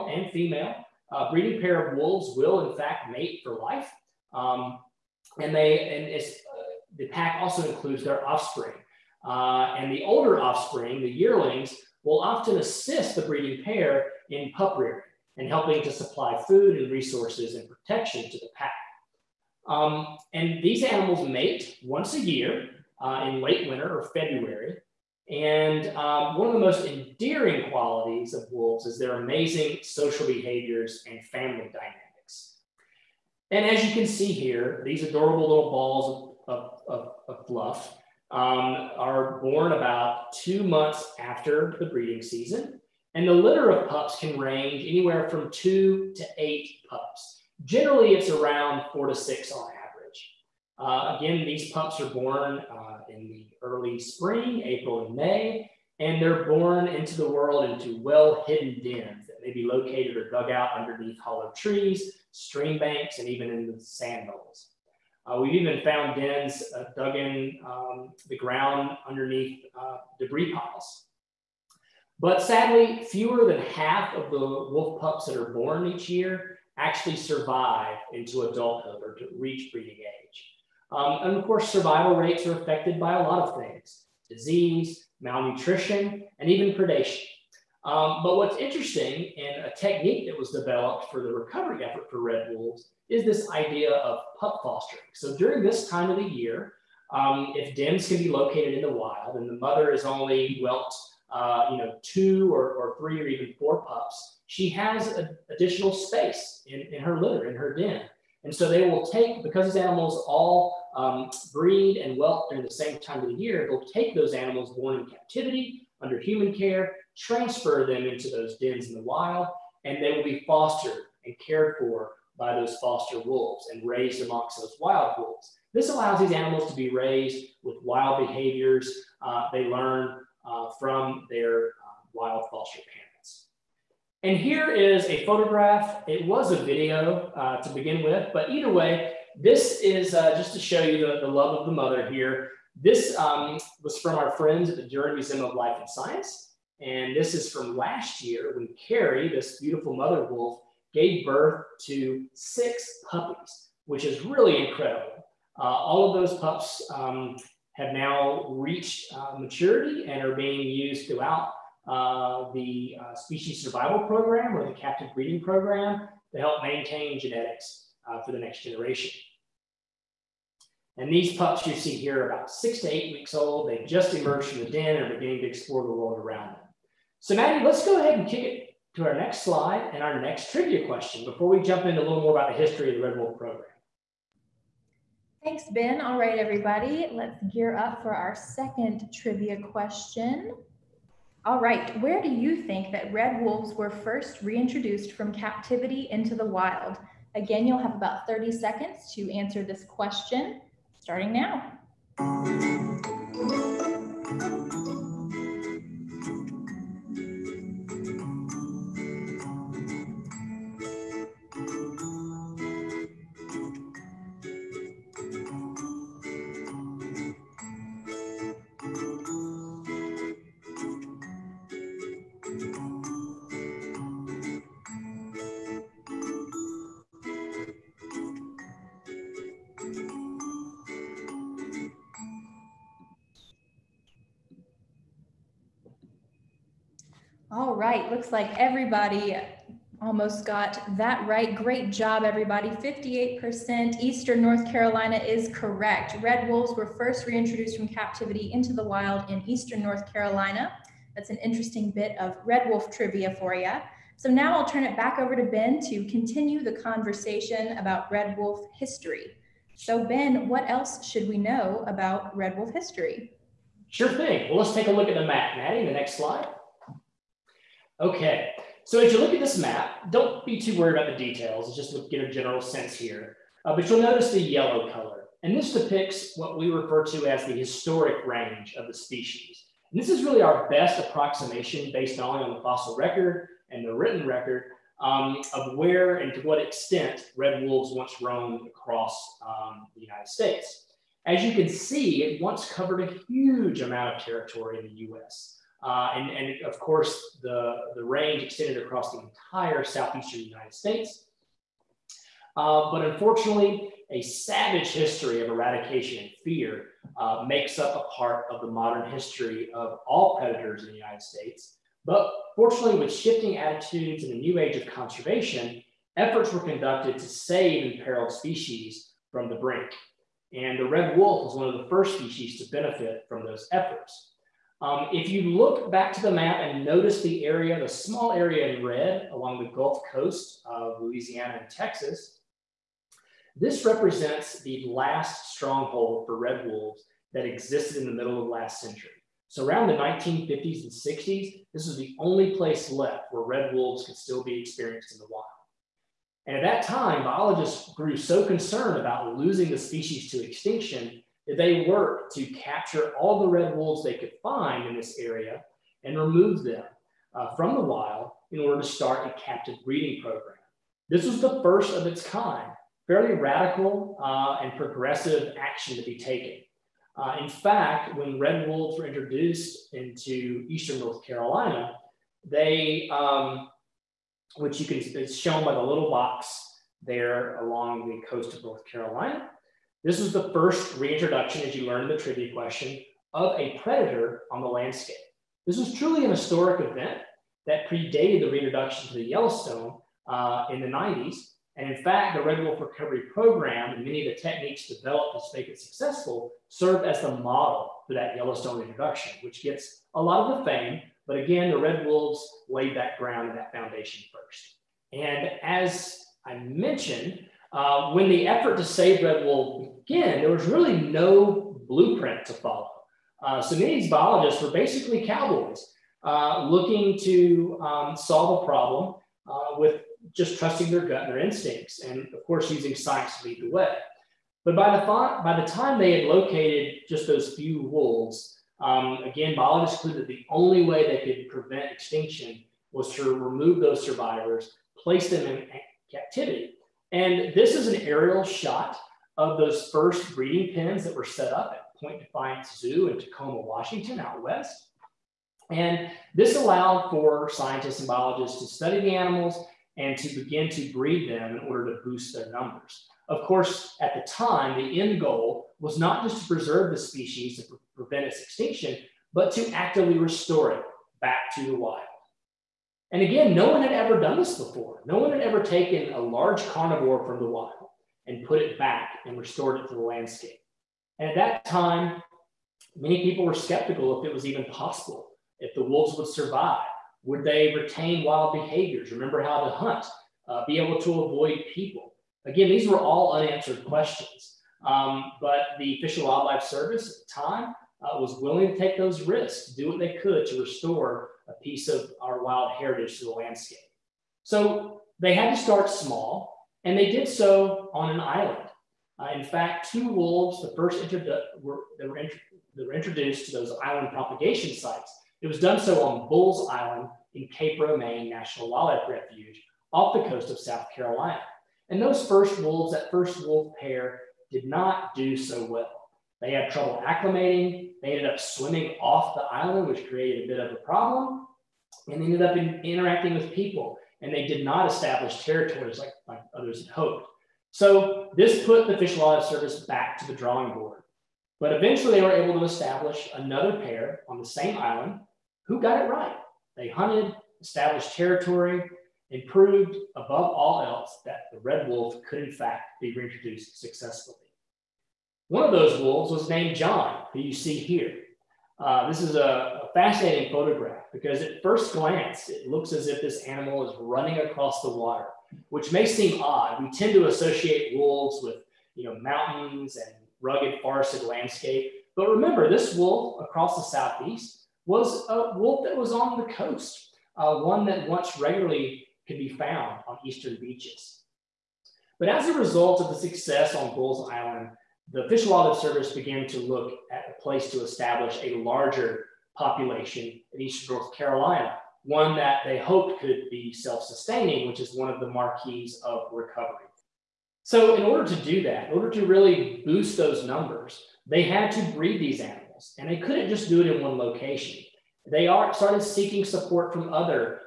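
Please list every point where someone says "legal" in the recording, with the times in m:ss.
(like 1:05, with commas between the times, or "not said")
not said.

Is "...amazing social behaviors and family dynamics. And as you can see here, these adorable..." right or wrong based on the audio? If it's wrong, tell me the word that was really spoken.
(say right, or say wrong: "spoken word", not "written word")
right.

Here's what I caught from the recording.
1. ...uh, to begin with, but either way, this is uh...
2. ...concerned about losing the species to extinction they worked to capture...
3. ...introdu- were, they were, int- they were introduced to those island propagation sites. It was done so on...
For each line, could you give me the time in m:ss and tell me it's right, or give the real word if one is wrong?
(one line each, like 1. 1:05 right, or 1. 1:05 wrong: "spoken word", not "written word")
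1. 2:17 right
2. 5:48 right
3. 8:21 right.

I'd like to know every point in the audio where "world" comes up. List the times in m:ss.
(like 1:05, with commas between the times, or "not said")
0:57, 2:55.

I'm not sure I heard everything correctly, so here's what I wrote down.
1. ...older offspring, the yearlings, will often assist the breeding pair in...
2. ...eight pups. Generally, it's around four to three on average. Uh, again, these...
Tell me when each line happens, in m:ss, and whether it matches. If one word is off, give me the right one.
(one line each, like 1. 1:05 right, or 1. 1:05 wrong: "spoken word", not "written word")
1. 0:10 right
2. 0:46 wrong: "six", not "three".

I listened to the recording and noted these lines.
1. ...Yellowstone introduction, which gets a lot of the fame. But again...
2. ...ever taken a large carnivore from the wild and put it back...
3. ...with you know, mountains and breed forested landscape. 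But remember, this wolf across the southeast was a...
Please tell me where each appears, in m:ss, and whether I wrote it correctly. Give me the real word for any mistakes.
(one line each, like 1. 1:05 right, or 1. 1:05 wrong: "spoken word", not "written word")
1. 6:38 right
2. 7:45 right
3. 9:18 wrong: "rugged", not "breed".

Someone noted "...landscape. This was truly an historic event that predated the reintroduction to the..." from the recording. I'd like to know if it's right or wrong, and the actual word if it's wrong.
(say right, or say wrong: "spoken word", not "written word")
right.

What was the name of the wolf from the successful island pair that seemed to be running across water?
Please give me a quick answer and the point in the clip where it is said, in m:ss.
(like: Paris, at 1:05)
John, at 9:06.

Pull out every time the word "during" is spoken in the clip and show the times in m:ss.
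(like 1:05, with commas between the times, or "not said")
1:35, 1:52.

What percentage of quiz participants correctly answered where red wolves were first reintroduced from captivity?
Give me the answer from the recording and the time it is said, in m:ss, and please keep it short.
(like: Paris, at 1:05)
58%, at 4:02.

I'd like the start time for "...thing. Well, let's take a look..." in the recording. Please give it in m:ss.
4:24.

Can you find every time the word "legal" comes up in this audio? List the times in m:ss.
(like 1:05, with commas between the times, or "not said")
not said.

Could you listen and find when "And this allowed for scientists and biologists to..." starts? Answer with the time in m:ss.
7:25.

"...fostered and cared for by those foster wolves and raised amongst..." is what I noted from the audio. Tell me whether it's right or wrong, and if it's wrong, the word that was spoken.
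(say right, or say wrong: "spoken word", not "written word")
right.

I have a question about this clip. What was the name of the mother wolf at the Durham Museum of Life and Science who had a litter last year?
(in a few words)
Carrie.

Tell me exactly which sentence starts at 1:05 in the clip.
Uh, we've even found dens uh, dug in um, the ground underneath uh, debris piles.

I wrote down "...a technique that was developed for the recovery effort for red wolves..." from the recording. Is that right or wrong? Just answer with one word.
right.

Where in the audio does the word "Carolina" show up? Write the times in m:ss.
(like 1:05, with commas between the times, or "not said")
4:04, 4:10, 6:11, 6:18, 8:30, 9:41.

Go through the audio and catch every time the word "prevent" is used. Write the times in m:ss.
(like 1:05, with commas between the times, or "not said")
7:11, 7:37.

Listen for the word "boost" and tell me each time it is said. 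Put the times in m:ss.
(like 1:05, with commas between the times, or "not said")
7:32, 9:49.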